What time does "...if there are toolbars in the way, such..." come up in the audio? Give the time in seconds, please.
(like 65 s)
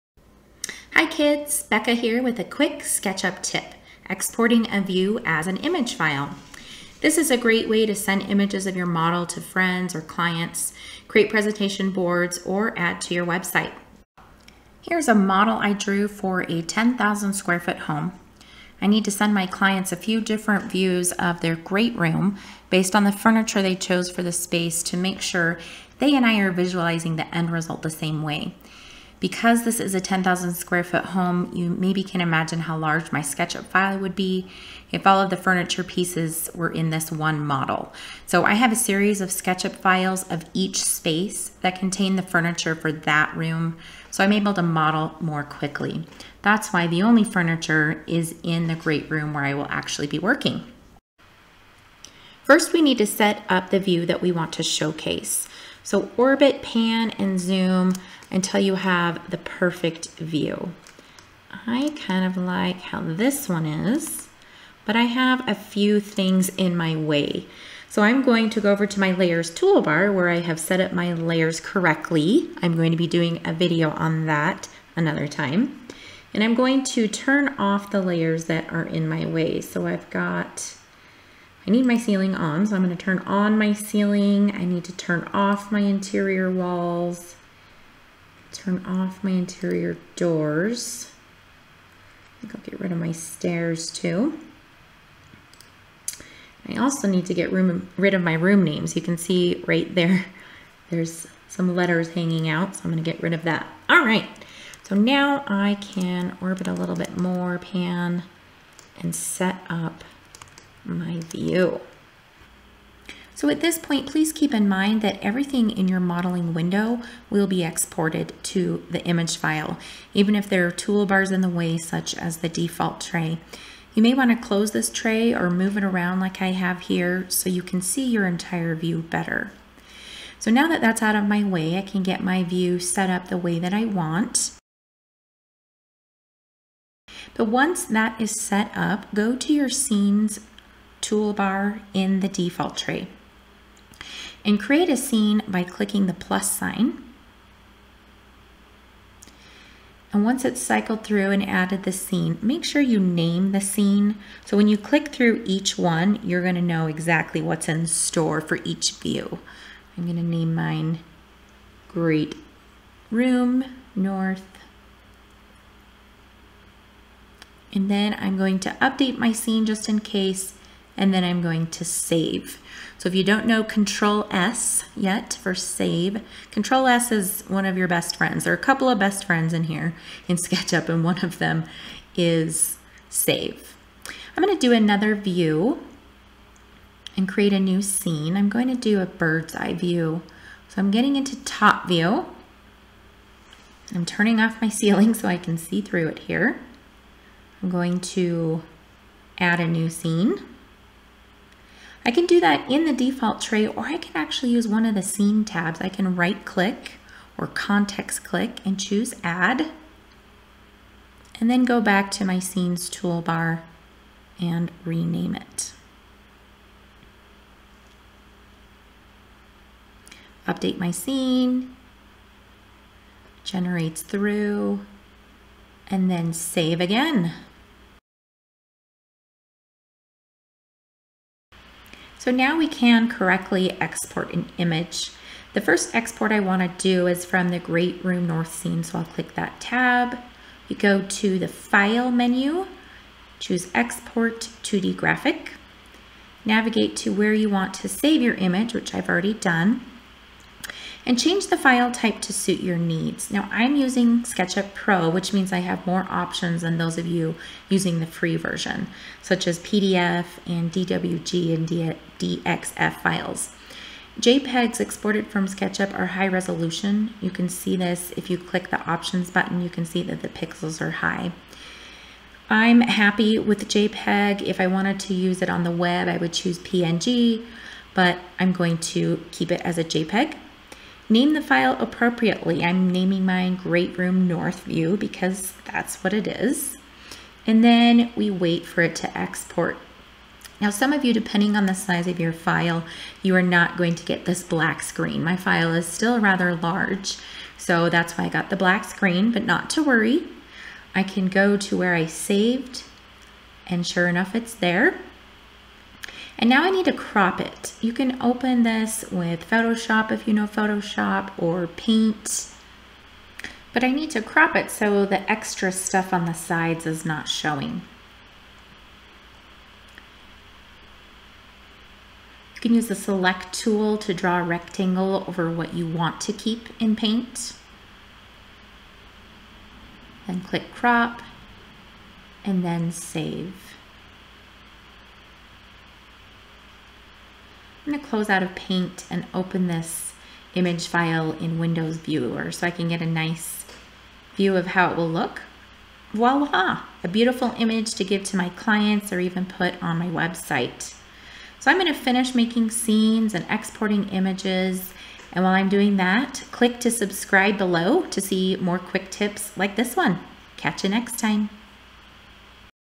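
120 s.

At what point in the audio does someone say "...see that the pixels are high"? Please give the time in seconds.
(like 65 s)
269 s.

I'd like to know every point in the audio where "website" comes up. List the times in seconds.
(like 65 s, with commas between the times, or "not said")
13 s, 350 s.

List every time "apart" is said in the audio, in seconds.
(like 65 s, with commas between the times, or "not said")
not said.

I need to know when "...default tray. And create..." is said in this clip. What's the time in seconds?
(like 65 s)
142 s.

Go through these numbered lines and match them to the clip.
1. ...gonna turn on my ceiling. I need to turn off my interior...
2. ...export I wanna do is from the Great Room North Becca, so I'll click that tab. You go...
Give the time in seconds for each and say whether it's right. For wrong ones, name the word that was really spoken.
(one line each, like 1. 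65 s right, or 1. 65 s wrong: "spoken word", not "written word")
1. 82 s right
2. 235 s wrong: "Scene", not "Becca".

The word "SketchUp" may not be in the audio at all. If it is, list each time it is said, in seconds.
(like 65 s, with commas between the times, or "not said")
2 s, 33 s, 39 s, 180 s, 254 s, 265 s.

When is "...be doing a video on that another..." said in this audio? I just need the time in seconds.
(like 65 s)
72 s.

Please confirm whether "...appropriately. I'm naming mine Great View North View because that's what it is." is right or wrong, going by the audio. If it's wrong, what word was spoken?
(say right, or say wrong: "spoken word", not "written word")
wrong: "Room", not "View".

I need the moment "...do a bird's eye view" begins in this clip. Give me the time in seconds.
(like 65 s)
188 s.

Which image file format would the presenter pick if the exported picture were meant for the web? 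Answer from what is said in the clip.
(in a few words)
PNG.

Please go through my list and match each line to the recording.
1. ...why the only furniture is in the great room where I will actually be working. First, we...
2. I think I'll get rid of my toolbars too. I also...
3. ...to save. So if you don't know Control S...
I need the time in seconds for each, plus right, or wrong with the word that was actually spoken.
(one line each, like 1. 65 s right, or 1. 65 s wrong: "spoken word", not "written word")
1. 46 s right
2. 92 s wrong: "stairs", not "toolbars"
3. 171 s right.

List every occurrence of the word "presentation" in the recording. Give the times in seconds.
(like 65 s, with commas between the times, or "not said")
11 s.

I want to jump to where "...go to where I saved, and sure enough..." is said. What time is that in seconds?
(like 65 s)
301 s.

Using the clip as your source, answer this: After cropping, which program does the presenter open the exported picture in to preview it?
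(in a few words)
Windows Viewer.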